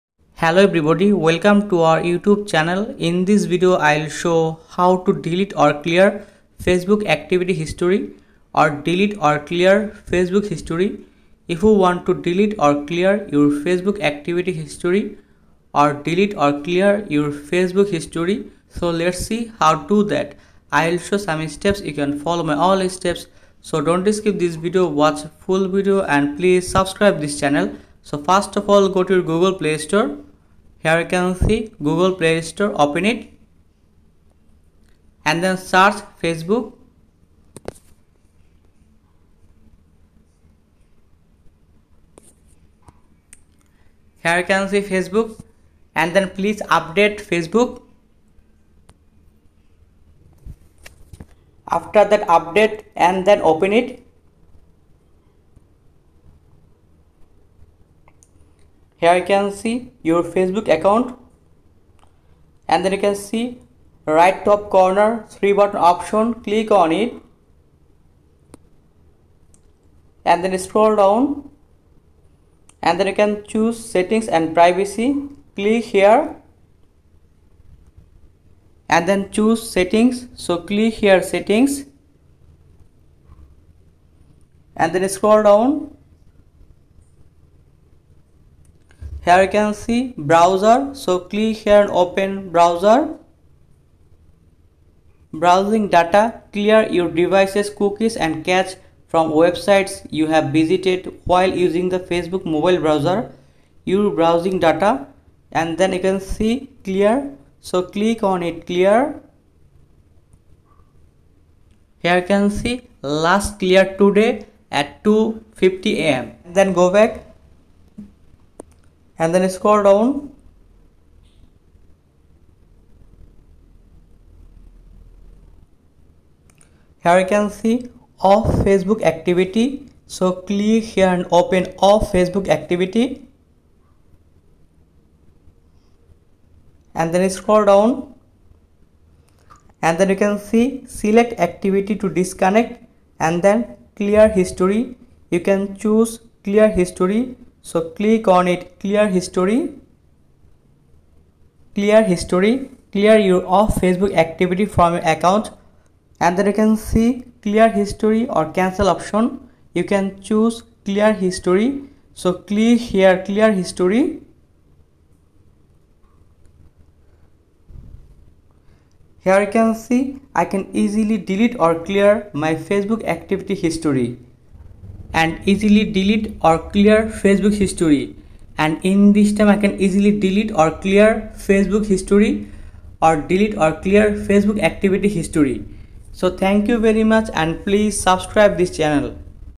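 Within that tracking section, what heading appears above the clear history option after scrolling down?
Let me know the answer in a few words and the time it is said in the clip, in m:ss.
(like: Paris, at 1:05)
Select activity to disconnect, at 2:20.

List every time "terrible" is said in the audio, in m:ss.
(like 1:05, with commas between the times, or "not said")
not said.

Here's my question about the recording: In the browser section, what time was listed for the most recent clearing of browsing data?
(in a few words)
2:50 am.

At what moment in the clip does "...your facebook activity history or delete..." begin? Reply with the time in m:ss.
0:13.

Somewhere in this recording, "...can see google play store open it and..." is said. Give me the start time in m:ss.
0:31.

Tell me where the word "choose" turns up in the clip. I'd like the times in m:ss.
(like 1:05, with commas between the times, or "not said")
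1:13, 1:19, 2:25, 2:40.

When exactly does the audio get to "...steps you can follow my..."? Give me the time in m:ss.
0:21.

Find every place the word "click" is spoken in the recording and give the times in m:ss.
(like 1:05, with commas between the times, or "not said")
1:06, 1:15, 1:20, 1:31, 1:47, 2:10, 2:27, 2:42.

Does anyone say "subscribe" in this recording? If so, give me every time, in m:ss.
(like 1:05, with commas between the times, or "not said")
0:26, 3:07.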